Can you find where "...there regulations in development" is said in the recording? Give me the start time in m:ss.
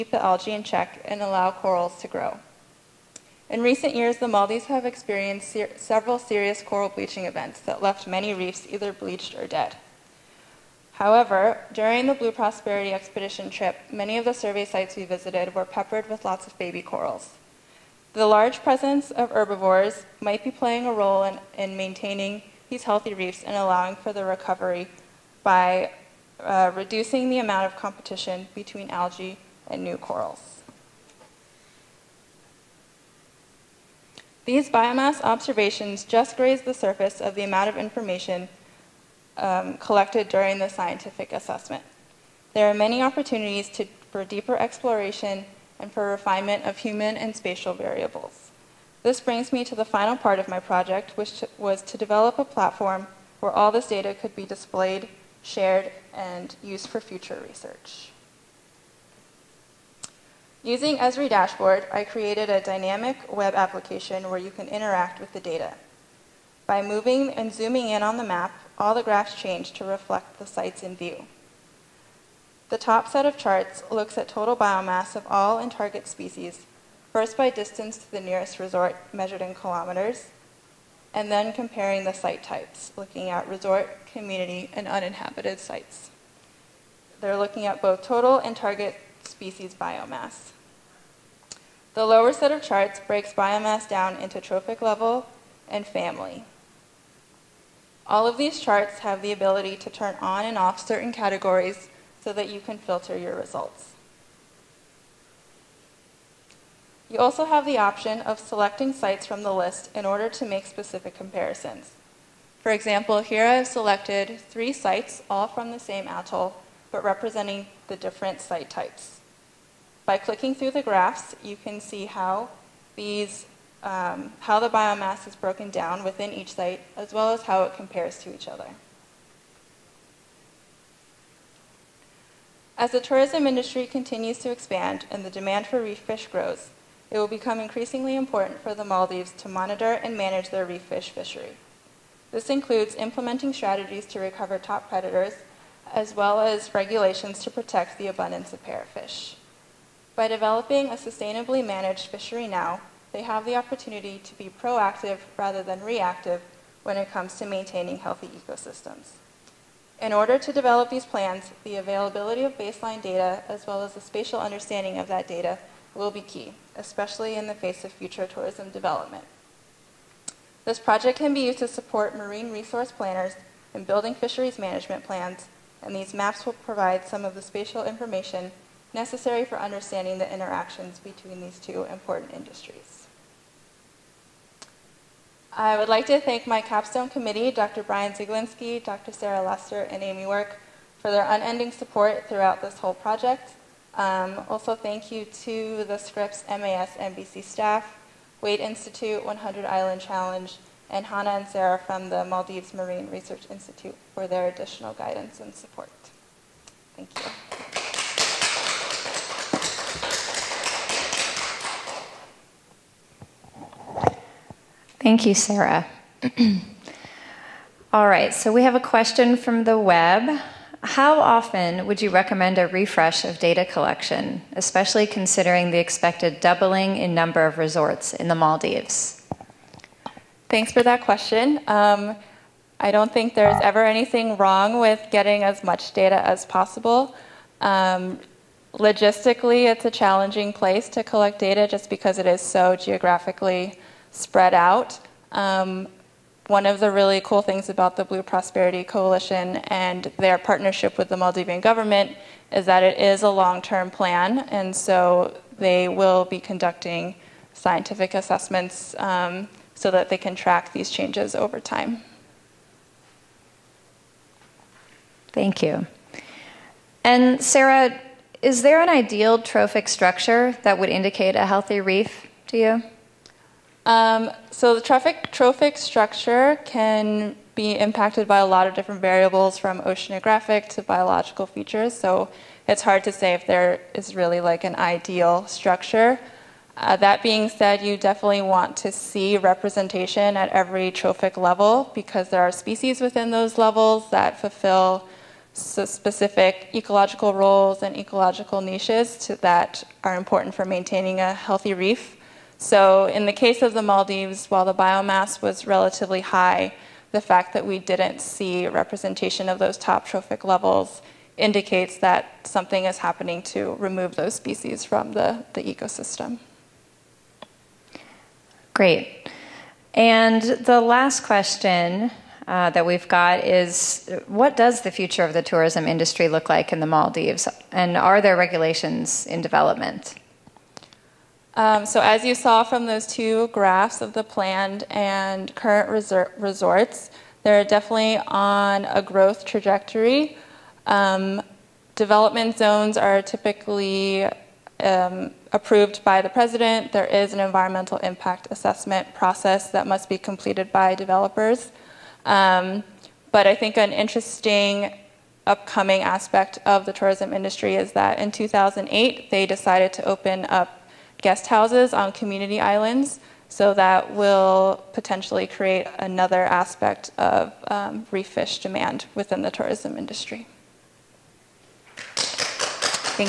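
5:28.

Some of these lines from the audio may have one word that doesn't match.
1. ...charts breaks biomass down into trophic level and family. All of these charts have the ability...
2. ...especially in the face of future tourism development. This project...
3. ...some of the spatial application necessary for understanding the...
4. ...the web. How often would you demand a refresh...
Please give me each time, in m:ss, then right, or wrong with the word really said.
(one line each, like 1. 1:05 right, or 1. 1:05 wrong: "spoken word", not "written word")
1. 1:32 right
2. 2:46 right
3. 2:57 wrong: "information", not "application"
4. 3:39 wrong: "recommend", not "demand".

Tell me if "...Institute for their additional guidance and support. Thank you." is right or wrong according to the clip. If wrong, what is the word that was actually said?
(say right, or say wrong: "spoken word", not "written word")
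right.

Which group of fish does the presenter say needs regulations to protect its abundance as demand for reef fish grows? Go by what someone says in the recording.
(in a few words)
parrotfish.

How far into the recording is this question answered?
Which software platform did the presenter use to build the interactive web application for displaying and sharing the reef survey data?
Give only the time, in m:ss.
1:00.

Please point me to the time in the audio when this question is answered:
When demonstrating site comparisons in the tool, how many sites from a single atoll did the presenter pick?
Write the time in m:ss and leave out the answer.
1:54.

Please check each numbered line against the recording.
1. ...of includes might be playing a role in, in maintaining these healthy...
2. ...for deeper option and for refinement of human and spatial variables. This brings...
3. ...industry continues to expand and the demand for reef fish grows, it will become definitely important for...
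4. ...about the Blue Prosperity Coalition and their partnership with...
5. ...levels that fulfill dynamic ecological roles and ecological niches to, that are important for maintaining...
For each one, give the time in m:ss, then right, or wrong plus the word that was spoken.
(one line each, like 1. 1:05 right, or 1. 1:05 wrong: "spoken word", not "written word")
1. 0:19 wrong: "herbivores", not "includes"
2. 0:44 wrong: "exploration", not "option"
3. 2:13 wrong: "increasingly", not "definitely"
4. 4:07 right
5. 4:53 wrong: "specific", not "dynamic".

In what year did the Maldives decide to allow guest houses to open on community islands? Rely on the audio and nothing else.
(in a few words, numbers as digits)
2008.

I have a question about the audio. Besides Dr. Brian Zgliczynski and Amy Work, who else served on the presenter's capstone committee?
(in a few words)
Dr. Sarah Lester.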